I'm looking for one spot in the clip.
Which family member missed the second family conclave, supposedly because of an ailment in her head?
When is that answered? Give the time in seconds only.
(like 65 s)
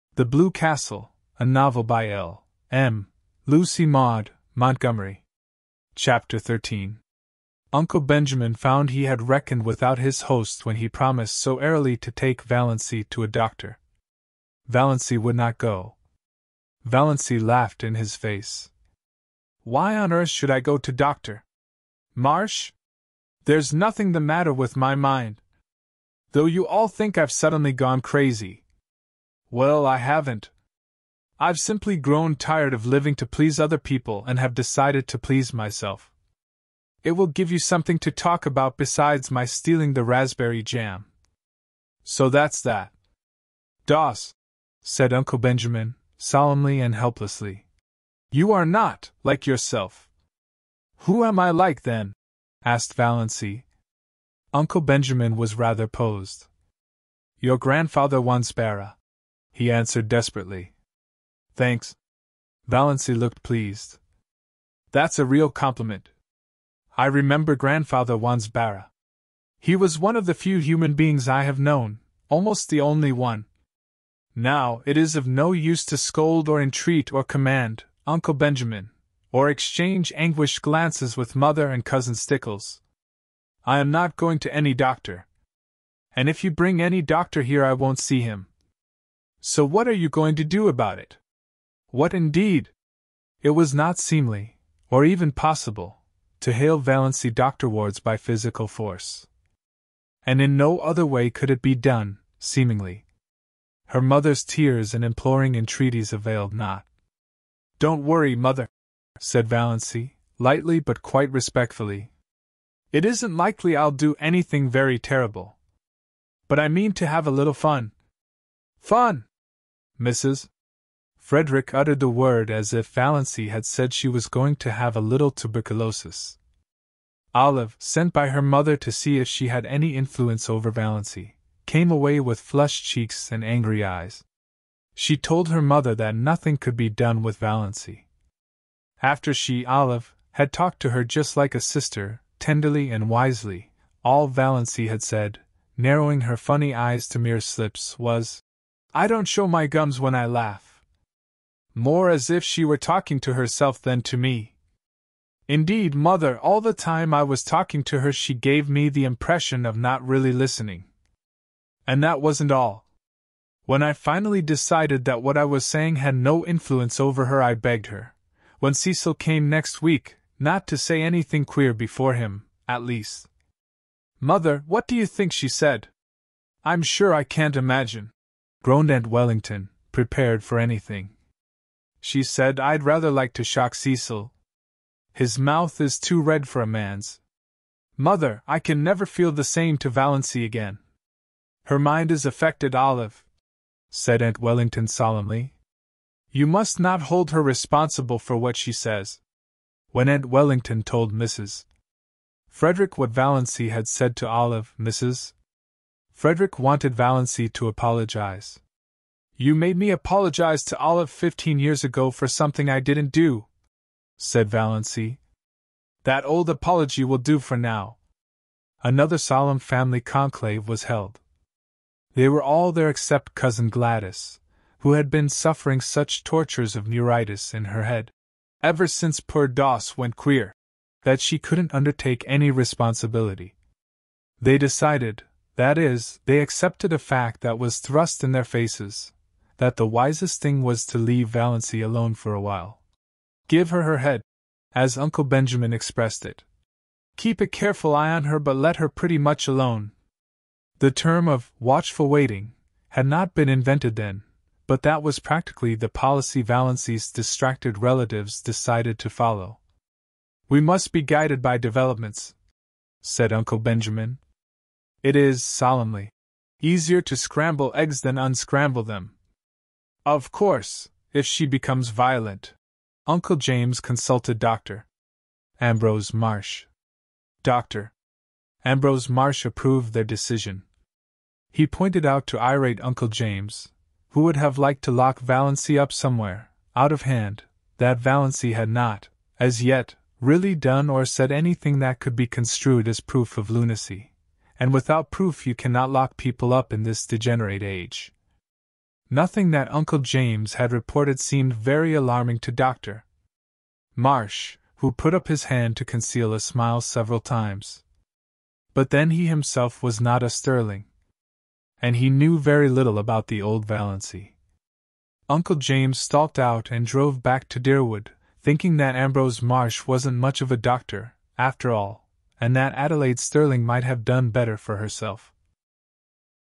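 223 s.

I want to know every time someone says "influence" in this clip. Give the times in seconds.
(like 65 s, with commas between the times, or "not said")
129 s, 166 s.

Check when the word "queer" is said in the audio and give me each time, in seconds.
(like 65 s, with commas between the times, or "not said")
171 s, 230 s.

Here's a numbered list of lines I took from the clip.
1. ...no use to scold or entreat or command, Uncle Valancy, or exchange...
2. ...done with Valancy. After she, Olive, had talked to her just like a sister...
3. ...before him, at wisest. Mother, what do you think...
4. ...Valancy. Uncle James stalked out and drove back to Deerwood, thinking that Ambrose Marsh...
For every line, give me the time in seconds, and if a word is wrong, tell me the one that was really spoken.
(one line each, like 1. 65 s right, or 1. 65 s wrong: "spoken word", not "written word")
1. 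75 s wrong: "Benjamin", not "Valancy"
2. 136 s right
3. 171 s wrong: "least", not "wisest"
4. 313 s right.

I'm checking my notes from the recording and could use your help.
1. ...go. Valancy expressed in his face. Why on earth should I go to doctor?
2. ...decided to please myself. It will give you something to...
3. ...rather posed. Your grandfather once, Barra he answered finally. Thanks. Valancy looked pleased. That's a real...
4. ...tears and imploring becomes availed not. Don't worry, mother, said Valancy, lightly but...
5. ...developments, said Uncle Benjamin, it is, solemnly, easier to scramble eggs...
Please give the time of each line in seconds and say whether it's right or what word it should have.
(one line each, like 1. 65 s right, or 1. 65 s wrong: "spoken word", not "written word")
1. 15 s wrong: "laughed", not "expressed"
2. 34 s right
3. 55 s wrong: "desperately", not "finally"
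4. 104 s wrong: "entreaties", not "becomes"
5. 261 s right.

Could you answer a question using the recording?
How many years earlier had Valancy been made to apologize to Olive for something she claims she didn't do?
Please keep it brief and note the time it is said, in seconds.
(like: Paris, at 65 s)
15, at 211 s.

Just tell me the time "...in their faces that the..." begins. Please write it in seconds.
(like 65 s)
238 s.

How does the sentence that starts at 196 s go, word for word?
You must not hold her responsible for what she says.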